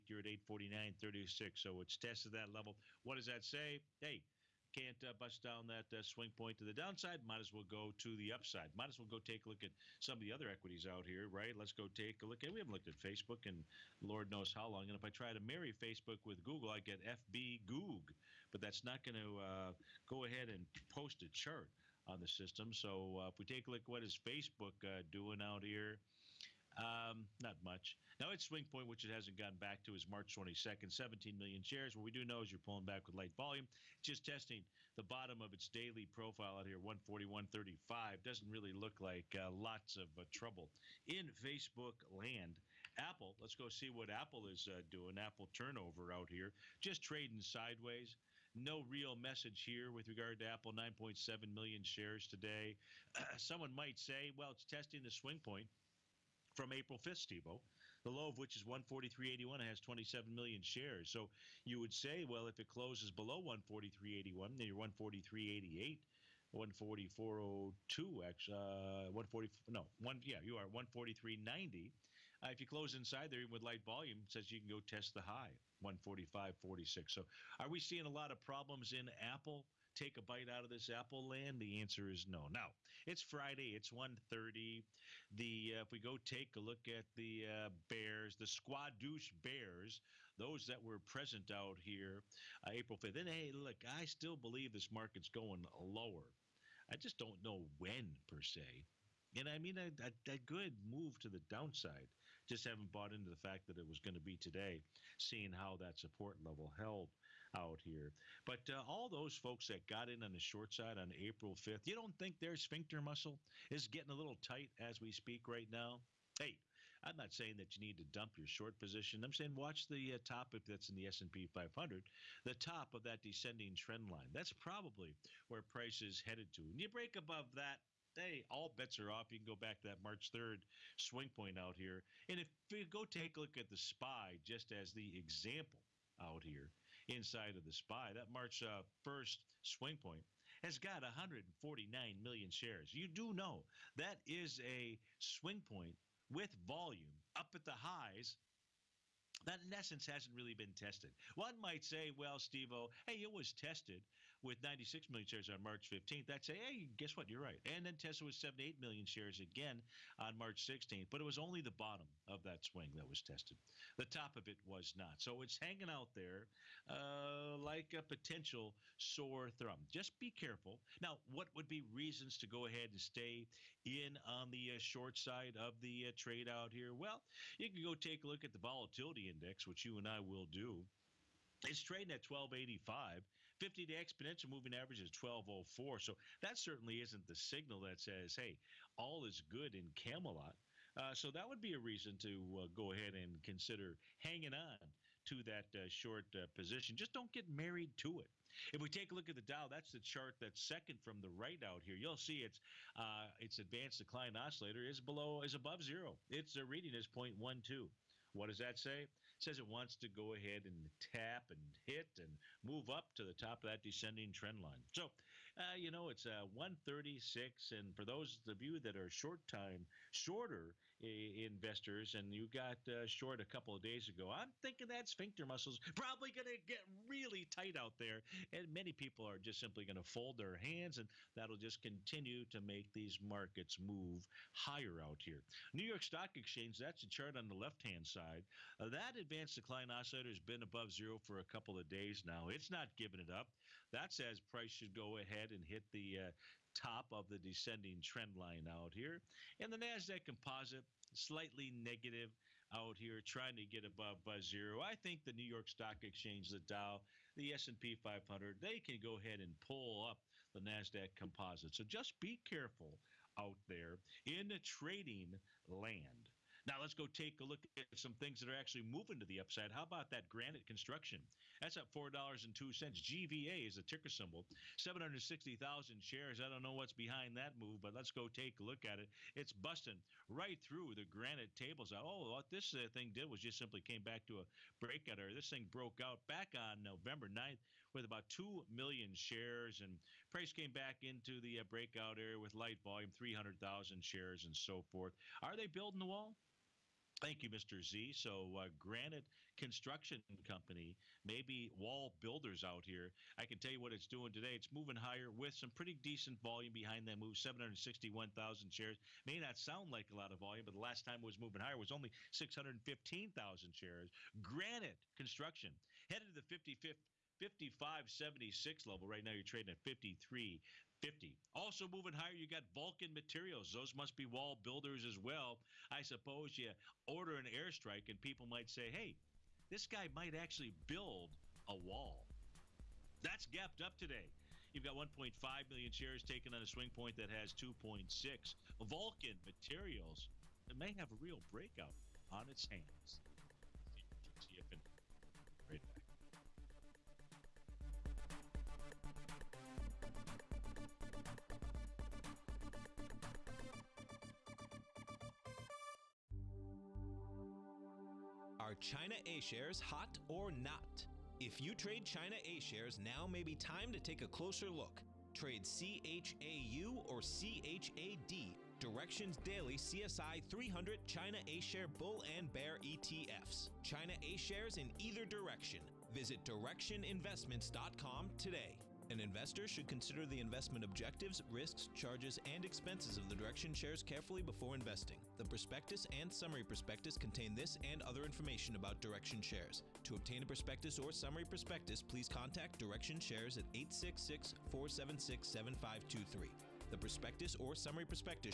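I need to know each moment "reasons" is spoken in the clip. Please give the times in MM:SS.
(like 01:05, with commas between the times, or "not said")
02:51, 03:11.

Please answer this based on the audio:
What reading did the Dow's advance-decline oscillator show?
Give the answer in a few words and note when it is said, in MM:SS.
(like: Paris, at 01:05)
0.12, at 03:27.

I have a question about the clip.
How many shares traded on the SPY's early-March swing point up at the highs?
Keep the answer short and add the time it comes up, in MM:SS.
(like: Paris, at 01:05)
149 million, at 02:21.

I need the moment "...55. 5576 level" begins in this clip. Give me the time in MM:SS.
05:16.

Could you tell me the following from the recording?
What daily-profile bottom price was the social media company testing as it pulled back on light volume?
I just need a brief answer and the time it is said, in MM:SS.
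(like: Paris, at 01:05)
141.35, at 00:36.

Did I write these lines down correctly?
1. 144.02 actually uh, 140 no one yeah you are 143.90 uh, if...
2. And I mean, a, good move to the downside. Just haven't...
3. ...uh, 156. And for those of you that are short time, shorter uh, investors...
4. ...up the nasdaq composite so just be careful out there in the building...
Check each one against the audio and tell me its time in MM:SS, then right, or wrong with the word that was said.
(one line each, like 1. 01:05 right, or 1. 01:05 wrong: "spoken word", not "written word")
1. 01:06 right
2. 01:39 right
3. 03:36 wrong: "136", not "156"
4. 04:20 wrong: "trading", not "building".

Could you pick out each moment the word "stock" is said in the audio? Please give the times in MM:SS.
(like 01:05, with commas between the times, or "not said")
03:56, 04:15.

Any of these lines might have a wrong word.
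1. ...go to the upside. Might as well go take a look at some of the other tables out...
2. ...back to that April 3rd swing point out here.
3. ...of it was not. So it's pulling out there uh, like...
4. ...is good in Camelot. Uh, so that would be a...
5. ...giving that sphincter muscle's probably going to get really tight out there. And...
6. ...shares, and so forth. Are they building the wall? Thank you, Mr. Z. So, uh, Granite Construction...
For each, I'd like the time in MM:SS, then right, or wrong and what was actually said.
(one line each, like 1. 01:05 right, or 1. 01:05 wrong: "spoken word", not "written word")
1. 00:07 wrong: "equities", not "tables"
2. 02:09 wrong: "March", not "April"
3. 02:44 wrong: "hanging", not "pulling"
4. 03:09 right
5. 03:44 wrong: "thinking", not "giving"
6. 04:54 right.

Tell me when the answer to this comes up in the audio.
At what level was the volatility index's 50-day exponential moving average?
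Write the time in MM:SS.
03:05.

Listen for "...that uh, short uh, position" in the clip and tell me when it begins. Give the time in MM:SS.
03:15.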